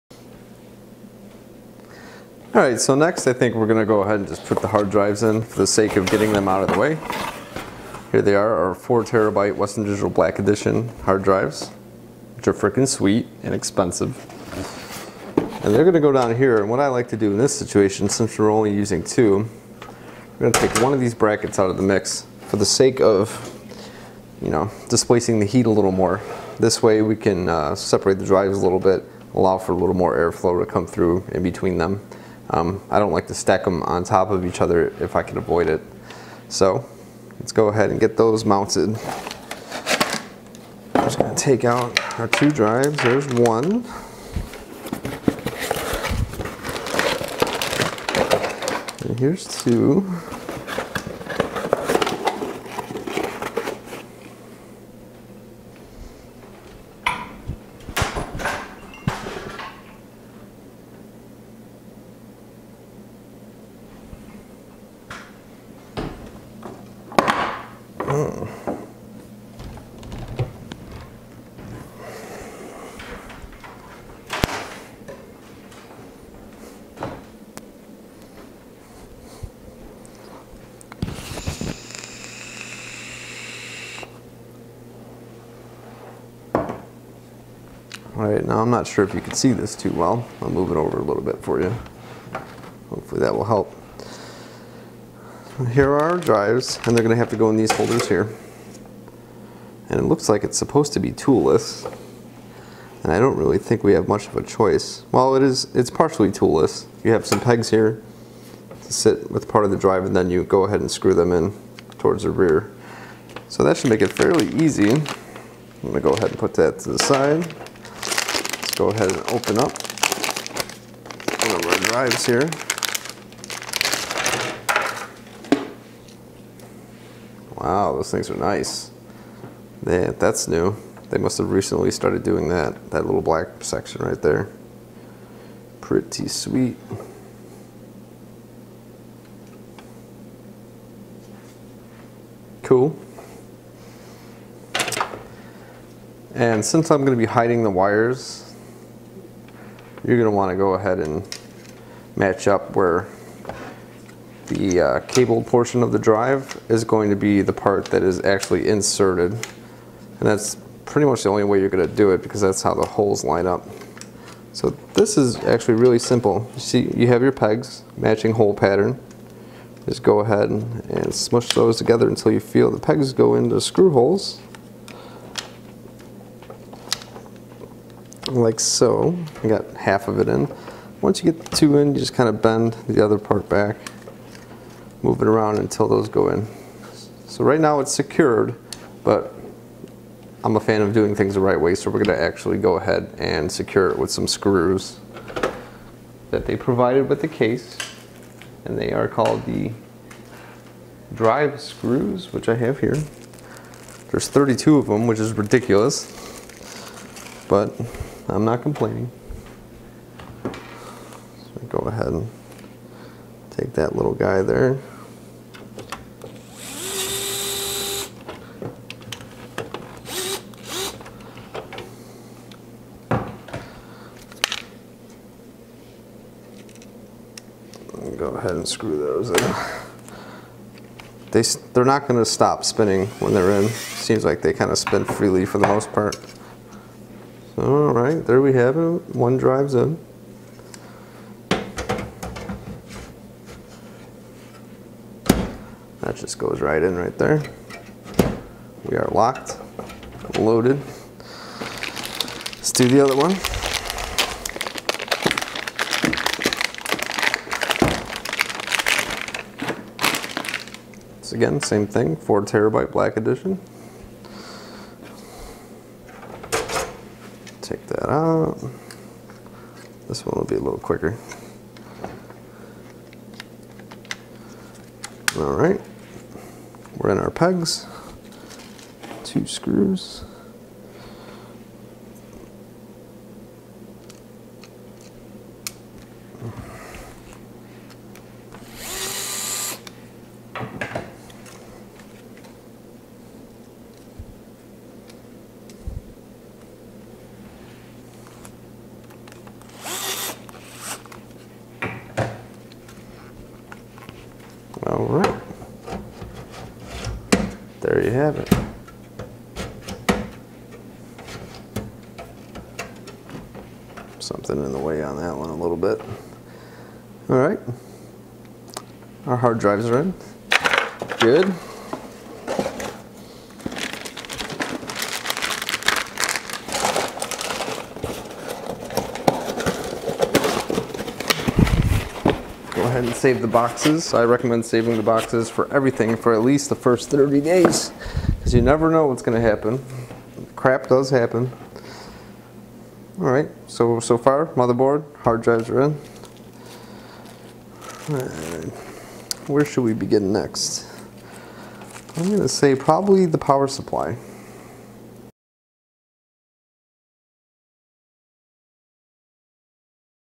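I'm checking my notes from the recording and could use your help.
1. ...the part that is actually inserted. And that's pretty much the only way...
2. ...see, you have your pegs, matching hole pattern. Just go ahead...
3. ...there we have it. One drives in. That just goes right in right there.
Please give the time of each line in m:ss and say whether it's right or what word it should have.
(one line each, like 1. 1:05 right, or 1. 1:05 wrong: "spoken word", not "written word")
1. 2:37 right
2. 2:46 right
3. 3:58 right.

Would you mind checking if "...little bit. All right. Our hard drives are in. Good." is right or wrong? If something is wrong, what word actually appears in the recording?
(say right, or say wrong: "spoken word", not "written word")
right.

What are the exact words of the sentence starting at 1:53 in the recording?
So that should make it fairly easy.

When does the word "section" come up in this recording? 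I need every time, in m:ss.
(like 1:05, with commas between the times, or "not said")
2:13.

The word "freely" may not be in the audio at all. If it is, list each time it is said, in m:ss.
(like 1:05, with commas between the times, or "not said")
3:55.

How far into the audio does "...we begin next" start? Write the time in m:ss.
5:49.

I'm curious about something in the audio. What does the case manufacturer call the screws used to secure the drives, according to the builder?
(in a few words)
Drive screws.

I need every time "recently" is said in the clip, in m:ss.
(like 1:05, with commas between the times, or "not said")
2:11.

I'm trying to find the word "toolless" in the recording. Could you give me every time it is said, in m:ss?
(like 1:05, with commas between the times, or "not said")
1:41, 1:46.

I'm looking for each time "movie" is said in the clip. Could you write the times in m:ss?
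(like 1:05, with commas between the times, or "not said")
not said.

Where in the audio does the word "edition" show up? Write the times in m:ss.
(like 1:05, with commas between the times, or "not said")
0:10, 4:23.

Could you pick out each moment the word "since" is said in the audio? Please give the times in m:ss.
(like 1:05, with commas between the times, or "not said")
0:18, 2:26.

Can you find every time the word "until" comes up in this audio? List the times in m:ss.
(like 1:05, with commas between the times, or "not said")
2:52, 3:05.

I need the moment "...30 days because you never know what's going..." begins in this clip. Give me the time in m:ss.
5:37.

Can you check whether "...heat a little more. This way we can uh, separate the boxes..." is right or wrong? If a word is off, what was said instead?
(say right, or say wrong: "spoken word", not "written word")
wrong: "drives", not "boxes".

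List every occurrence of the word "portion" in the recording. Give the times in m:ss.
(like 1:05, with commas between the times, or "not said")
2:35.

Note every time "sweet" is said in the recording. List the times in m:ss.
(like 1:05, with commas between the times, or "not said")
0:12, 2:16.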